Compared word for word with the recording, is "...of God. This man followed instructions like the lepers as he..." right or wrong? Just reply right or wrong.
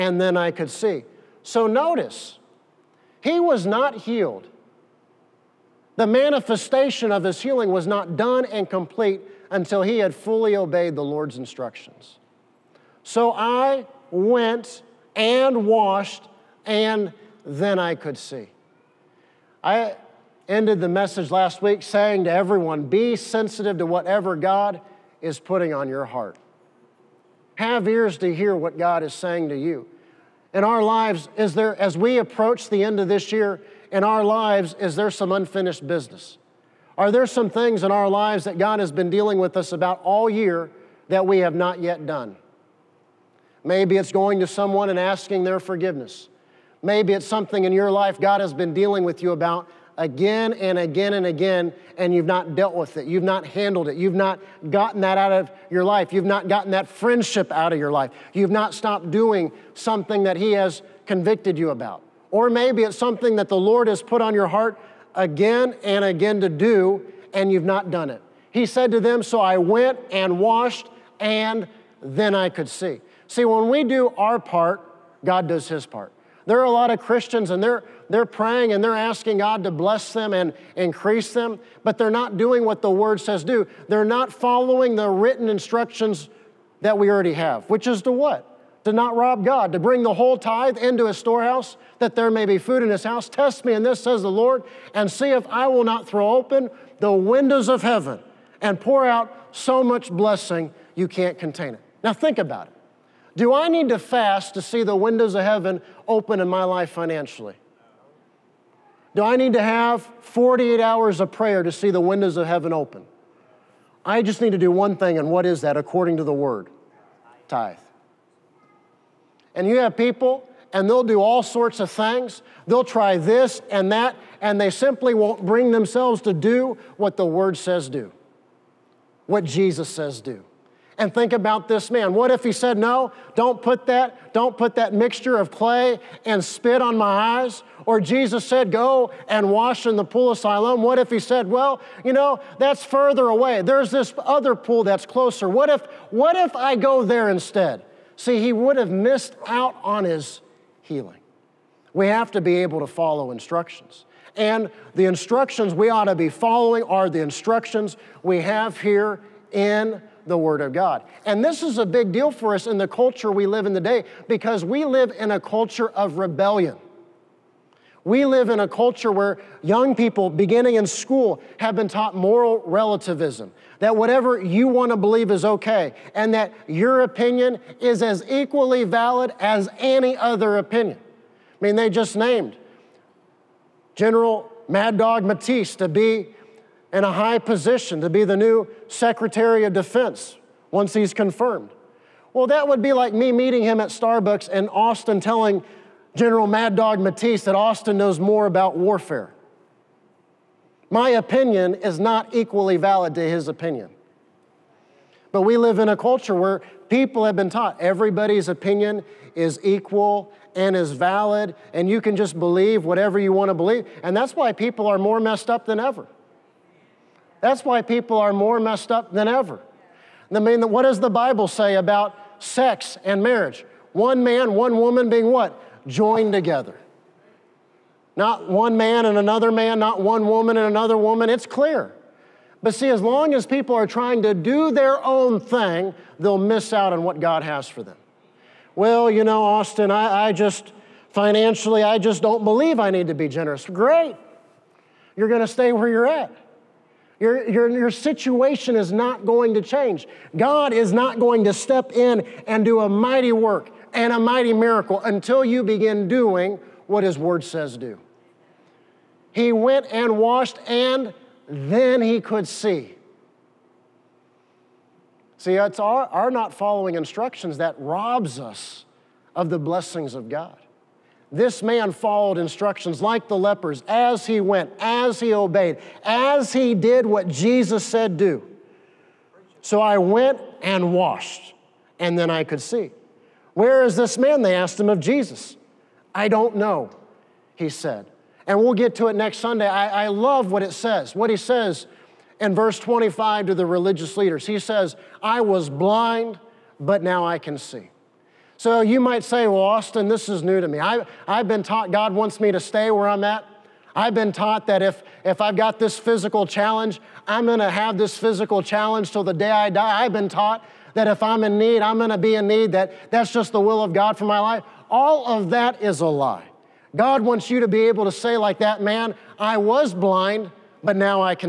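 right.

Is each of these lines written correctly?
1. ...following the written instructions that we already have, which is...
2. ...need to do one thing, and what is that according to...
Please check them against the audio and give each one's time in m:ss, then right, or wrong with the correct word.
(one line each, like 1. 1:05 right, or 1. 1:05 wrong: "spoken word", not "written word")
1. 1:24 right
2. 1:54 right.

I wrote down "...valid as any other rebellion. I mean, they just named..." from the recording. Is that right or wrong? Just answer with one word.
wrong.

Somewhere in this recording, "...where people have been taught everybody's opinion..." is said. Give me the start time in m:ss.
3:26.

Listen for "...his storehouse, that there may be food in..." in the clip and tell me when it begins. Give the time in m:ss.
1:31.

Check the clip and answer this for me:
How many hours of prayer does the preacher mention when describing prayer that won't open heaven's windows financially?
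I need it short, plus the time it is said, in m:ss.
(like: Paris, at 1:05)
48, at 1:50.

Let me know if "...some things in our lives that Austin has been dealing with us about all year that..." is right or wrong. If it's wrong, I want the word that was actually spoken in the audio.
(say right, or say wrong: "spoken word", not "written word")
wrong: "God", not "Austin".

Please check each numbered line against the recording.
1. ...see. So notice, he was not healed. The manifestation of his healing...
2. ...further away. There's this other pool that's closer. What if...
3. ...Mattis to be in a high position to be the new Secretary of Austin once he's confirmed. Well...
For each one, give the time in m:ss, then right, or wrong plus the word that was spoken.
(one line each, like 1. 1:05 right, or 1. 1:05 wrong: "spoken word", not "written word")
1. 0:00 right
2. 2:22 right
3. 3:05 wrong: "Defense", not "Austin".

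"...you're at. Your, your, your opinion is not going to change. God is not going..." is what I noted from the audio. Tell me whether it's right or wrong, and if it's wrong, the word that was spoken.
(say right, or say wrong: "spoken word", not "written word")
wrong: "situation", not "opinion".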